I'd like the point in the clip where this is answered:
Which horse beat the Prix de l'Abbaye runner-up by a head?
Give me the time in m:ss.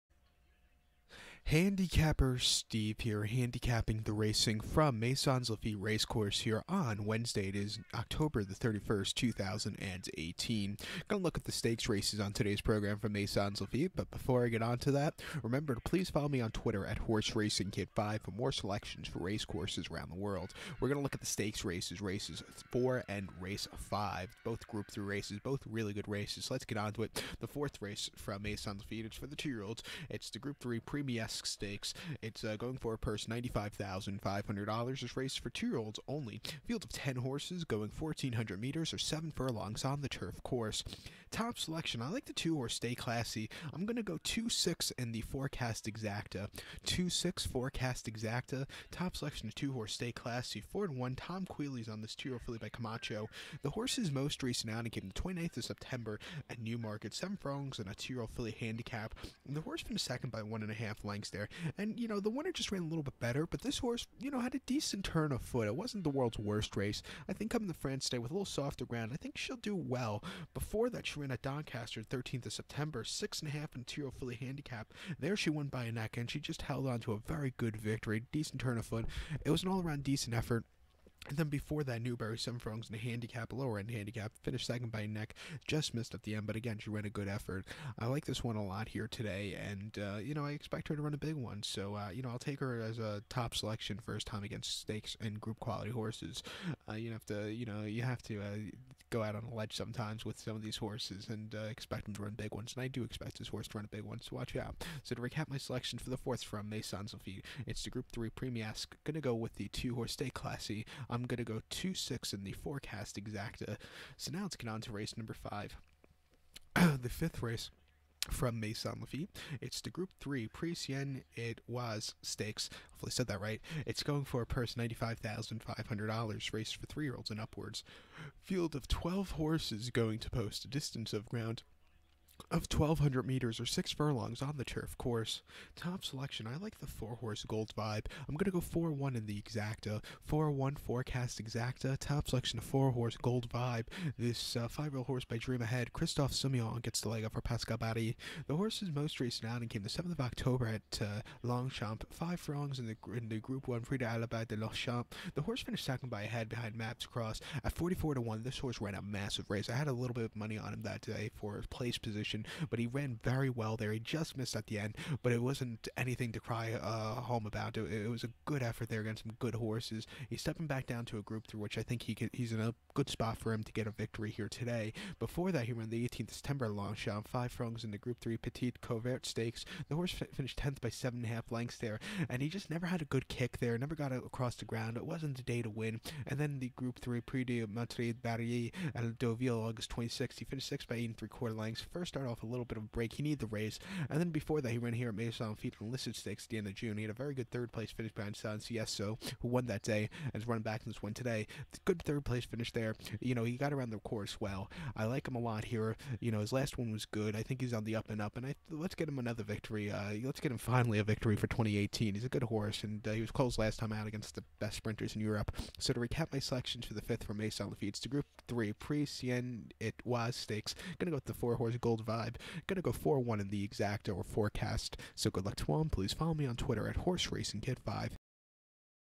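2:36.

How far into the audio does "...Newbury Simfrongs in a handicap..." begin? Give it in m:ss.
1:22.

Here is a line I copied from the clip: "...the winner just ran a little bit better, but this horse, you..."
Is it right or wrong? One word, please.
right.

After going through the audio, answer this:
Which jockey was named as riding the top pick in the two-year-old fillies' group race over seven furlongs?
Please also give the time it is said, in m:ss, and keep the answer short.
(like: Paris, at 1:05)
Tom Queally, at 0:51.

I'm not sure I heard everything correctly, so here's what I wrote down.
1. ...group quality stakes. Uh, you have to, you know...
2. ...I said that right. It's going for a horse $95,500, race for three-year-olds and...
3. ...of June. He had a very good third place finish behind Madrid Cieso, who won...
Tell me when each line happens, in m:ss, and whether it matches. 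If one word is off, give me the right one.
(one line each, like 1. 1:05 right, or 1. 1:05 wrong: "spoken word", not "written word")
1. 1:35 wrong: "horses", not "stakes"
2. 2:03 wrong: "purse", not "horse"
3. 3:16 wrong: "San", not "Madrid".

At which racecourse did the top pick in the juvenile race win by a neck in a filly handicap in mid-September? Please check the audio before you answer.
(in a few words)
Doncaster.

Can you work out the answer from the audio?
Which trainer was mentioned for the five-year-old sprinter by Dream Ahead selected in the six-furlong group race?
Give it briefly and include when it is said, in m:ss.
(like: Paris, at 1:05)
Pascal Bary, at 2:27.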